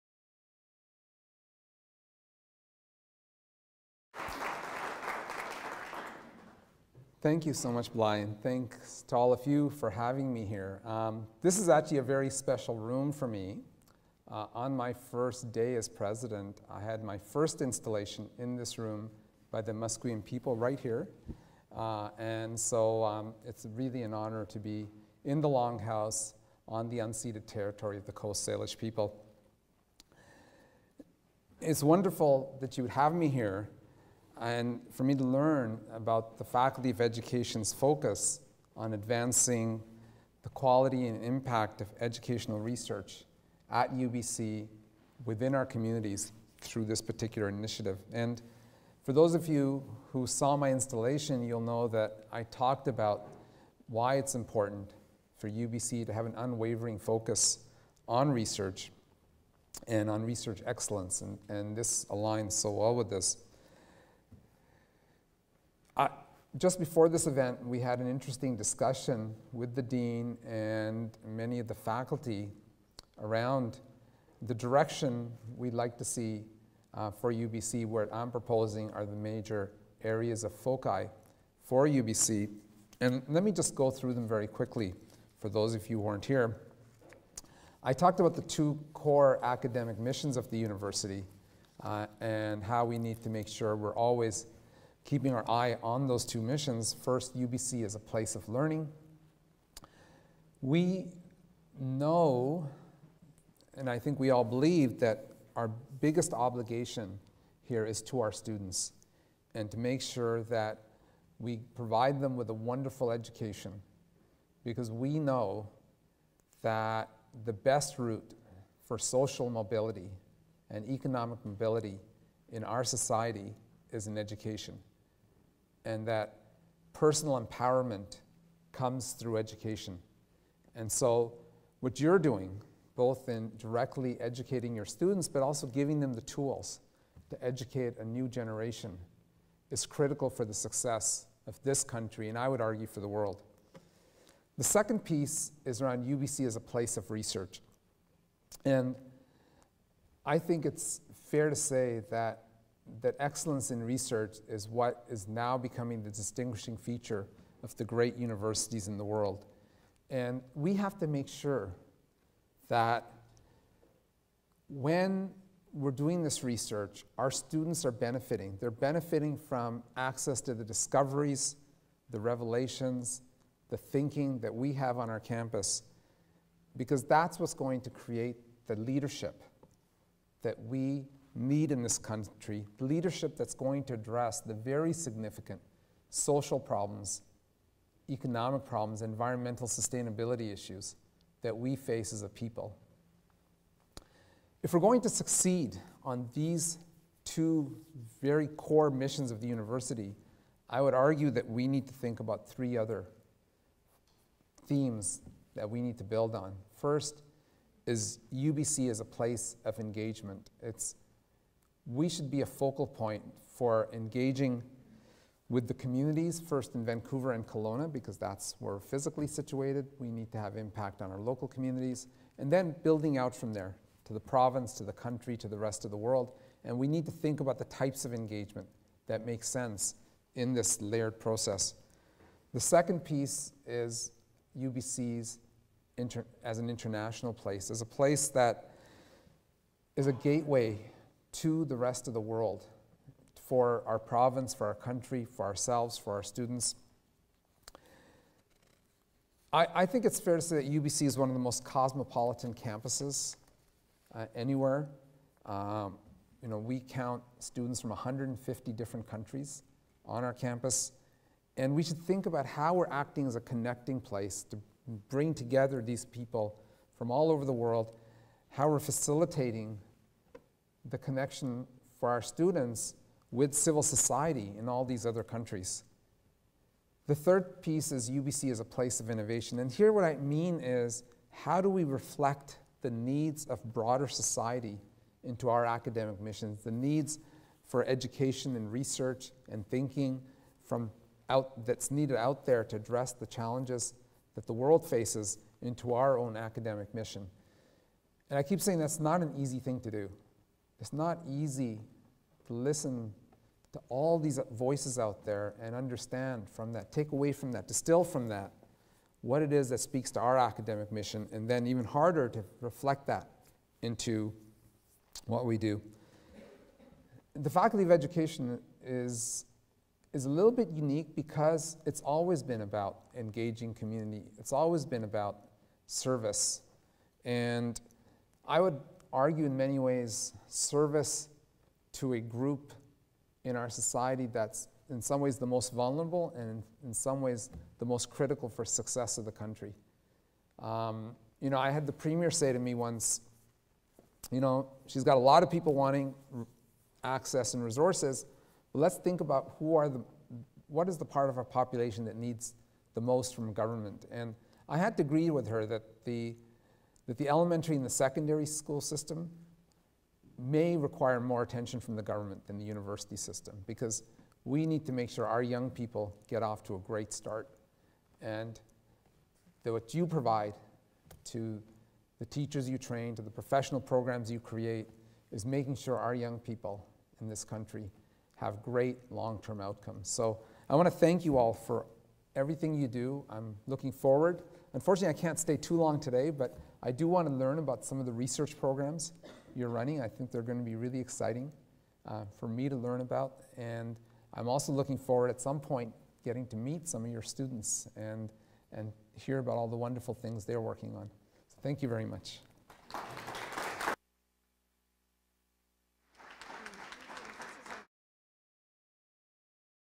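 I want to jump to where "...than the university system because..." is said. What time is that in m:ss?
6:02.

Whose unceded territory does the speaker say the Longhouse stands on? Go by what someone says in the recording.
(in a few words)
Coast Salish people.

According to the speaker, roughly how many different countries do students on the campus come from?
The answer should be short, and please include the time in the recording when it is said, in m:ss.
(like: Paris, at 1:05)
150, at 4:17.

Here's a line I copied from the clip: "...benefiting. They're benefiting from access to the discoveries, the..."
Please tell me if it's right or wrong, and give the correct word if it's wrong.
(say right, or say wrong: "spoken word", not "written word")
right.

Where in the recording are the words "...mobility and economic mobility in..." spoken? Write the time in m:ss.
1:59.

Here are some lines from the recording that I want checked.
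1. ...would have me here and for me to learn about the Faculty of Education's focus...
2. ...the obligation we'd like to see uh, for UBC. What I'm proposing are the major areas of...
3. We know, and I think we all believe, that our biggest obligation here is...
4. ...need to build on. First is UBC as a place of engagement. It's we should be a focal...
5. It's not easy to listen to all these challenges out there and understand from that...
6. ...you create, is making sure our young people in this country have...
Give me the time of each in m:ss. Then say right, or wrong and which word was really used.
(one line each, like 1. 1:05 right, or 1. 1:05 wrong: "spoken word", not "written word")
1. 0:32 right
2. 1:14 wrong: "direction", not "obligation"
3. 1:40 right
4. 3:25 right
5. 5:00 wrong: "voices", not "challenges"
6. 6:14 right.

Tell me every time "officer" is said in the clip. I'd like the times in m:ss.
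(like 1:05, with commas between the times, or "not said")
not said.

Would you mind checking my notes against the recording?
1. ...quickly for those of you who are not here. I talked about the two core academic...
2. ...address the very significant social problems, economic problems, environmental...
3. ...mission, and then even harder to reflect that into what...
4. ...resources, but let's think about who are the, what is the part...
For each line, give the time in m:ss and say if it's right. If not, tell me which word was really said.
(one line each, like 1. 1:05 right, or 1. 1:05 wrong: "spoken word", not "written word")
1. 1:24 right
2. 3:03 right
3. 5:10 right
4. 5:47 right.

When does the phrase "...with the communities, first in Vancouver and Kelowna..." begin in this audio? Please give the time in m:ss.
3:35.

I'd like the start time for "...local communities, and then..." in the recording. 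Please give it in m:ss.
3:41.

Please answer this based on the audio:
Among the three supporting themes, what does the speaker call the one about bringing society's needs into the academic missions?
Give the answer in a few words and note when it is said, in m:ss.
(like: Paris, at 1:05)
innovation, at 4:39.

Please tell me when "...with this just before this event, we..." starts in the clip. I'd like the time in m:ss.
1:02.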